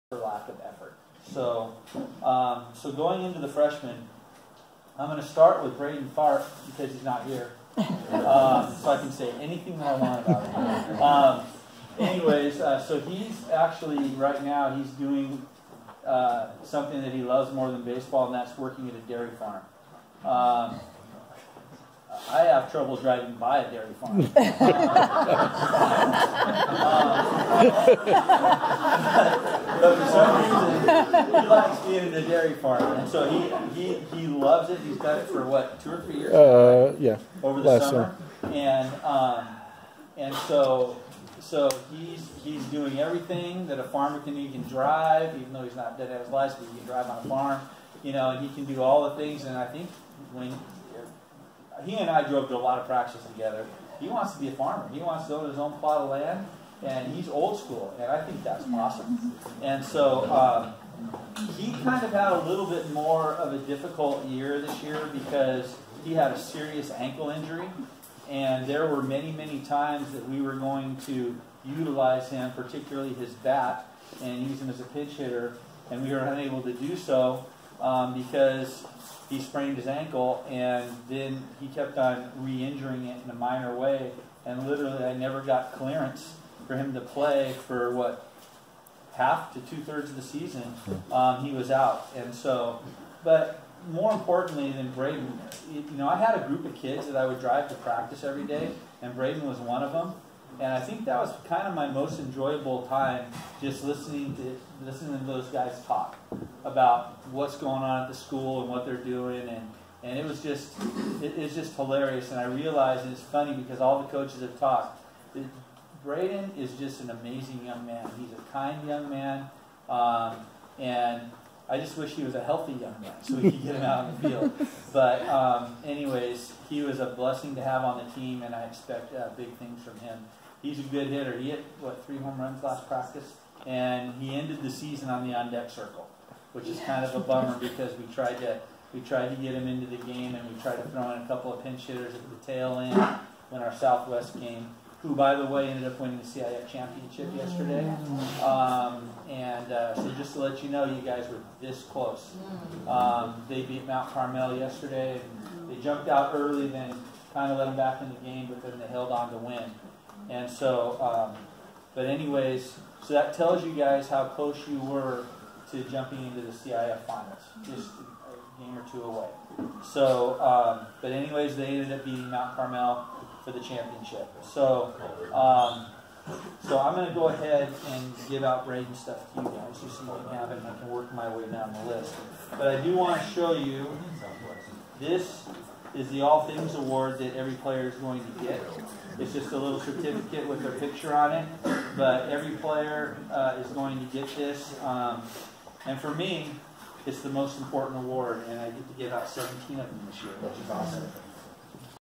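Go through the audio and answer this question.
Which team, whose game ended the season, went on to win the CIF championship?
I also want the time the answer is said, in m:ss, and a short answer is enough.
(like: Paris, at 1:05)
Southwest, at 2:23.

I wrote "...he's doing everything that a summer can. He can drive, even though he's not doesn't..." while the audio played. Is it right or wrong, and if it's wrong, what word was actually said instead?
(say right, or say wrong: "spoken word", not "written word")
wrong: "farmer", not "summer".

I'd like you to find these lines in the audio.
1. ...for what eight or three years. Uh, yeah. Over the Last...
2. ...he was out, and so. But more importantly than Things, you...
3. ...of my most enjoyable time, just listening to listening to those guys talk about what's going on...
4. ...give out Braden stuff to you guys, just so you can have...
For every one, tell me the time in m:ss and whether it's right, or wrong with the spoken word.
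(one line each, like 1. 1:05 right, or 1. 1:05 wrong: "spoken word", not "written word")
1. 0:35 wrong: "two", not "eight"
2. 1:31 wrong: "Braden", not "Things"
3. 1:41 right
4. 2:58 right.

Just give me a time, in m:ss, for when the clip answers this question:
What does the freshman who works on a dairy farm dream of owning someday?
0:55.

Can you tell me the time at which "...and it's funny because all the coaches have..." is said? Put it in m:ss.
1:53.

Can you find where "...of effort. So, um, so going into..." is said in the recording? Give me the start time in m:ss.
0:00.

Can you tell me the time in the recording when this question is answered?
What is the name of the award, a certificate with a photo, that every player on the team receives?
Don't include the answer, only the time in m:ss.
3:06.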